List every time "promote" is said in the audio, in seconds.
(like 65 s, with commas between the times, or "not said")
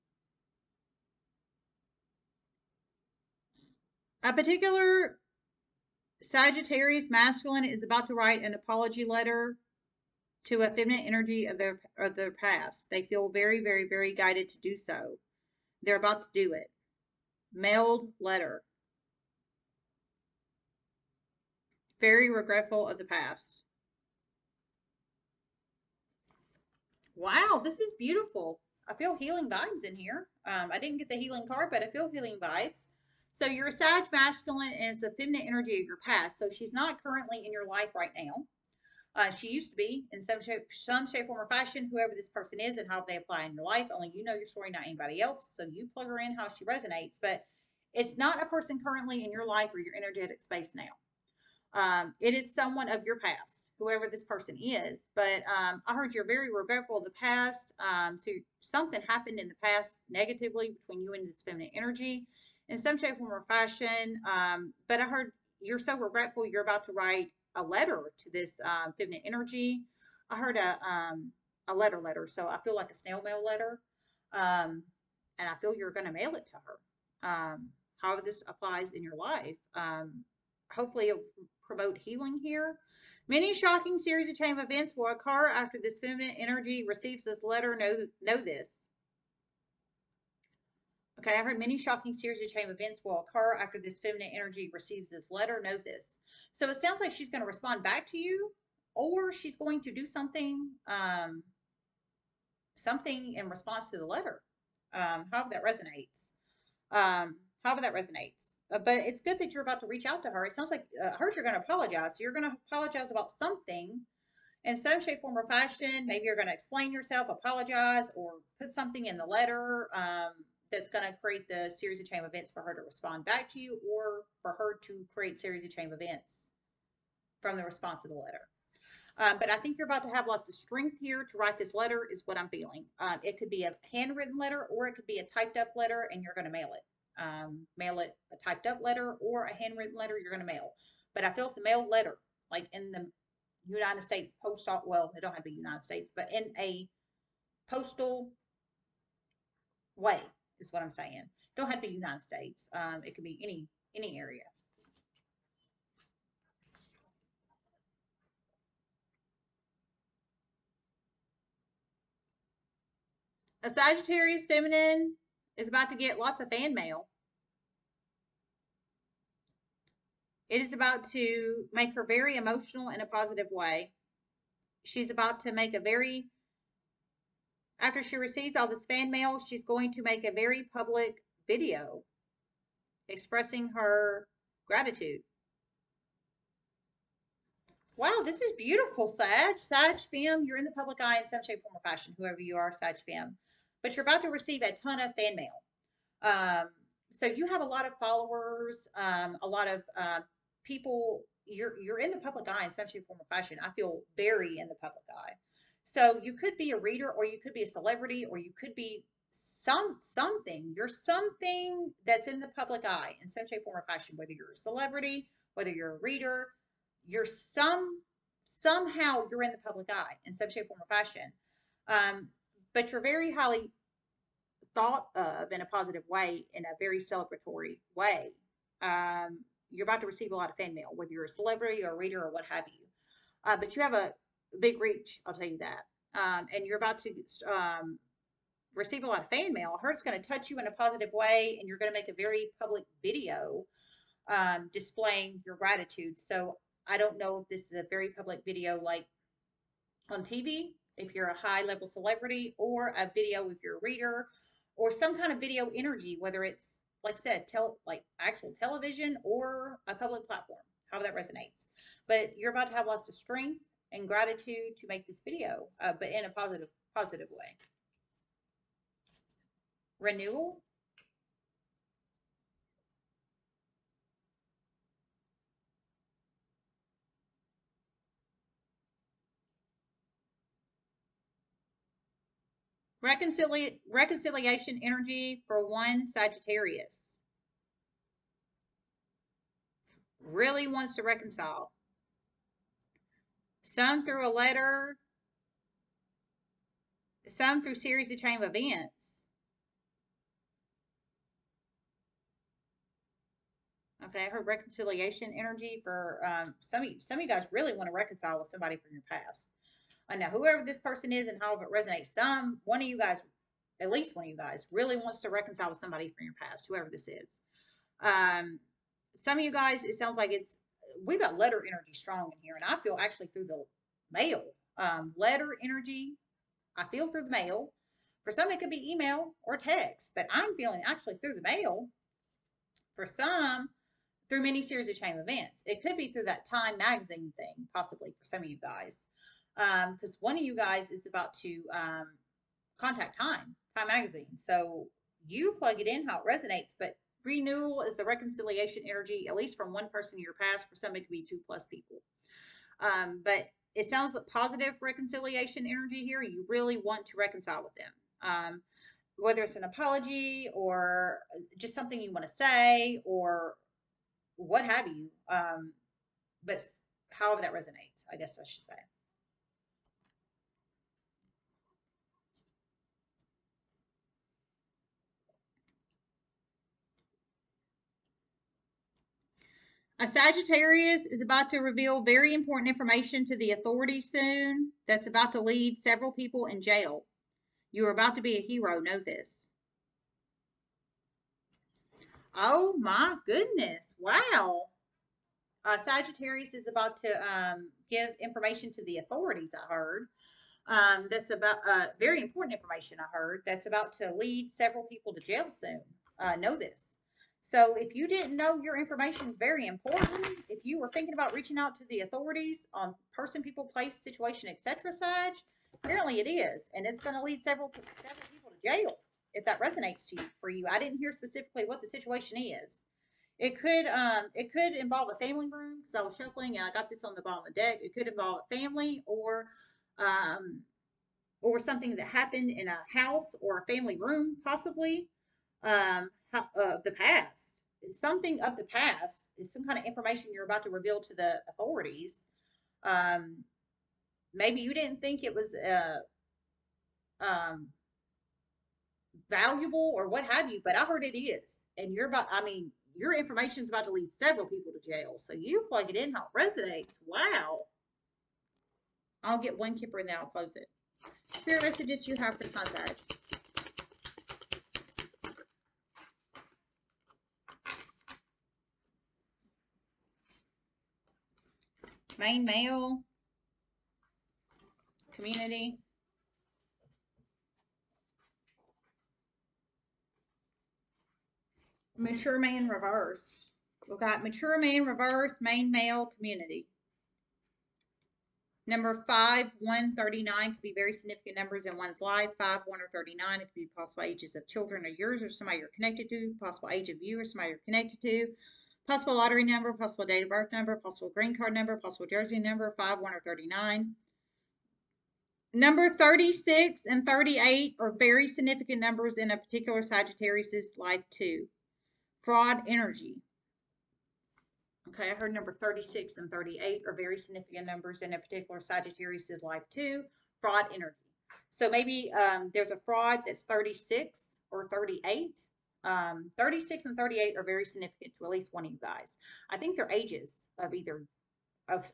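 81 s.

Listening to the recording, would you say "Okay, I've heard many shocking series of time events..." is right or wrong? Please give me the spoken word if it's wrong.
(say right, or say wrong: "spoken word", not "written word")
right.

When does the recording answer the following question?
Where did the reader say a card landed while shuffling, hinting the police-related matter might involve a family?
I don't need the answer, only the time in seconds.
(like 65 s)
427 s.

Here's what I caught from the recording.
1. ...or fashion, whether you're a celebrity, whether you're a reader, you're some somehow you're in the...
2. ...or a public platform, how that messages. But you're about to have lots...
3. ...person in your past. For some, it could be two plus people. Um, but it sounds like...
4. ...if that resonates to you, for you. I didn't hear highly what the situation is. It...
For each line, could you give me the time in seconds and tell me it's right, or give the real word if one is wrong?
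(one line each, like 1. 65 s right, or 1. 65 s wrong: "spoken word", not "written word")
1. 213 s right
2. 259 s wrong: "resonates", not "messages"
3. 349 s right
4. 419 s wrong: "specifically", not "highly".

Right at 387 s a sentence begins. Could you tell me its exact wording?
You are about to be a hero.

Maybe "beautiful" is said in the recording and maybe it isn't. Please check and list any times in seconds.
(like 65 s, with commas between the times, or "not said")
27 s, 188 s.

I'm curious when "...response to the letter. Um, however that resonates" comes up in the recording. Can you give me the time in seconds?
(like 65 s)
103 s.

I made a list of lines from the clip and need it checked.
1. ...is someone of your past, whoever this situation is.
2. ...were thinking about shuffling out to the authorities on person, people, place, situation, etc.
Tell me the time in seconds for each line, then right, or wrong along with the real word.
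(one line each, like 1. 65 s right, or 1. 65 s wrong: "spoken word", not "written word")
1. 52 s wrong: "person", not "situation"
2. 410 s wrong: "reaching", not "shuffling".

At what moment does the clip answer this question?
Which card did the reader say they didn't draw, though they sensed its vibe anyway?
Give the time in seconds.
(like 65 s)
31 s.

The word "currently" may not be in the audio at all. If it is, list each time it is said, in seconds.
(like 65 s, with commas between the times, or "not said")
37 s, 48 s.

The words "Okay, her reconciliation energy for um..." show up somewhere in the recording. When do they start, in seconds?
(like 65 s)
304 s.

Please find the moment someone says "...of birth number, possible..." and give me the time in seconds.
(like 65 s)
500 s.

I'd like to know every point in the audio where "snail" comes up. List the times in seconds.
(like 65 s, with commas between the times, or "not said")
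72 s.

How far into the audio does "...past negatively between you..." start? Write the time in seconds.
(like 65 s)
59 s.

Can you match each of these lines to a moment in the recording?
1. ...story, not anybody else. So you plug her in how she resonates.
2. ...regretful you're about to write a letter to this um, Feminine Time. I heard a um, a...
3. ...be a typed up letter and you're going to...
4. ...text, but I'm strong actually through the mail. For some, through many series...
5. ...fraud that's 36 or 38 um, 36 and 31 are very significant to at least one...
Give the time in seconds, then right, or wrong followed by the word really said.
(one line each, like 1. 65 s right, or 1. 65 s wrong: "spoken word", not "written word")
1. 44 s right
2. 65 s wrong: "Energy", not "Time"
3. 135 s right
4. 329 s wrong: "feeling", not "strong"
5. 522 s wrong: "38", not "31".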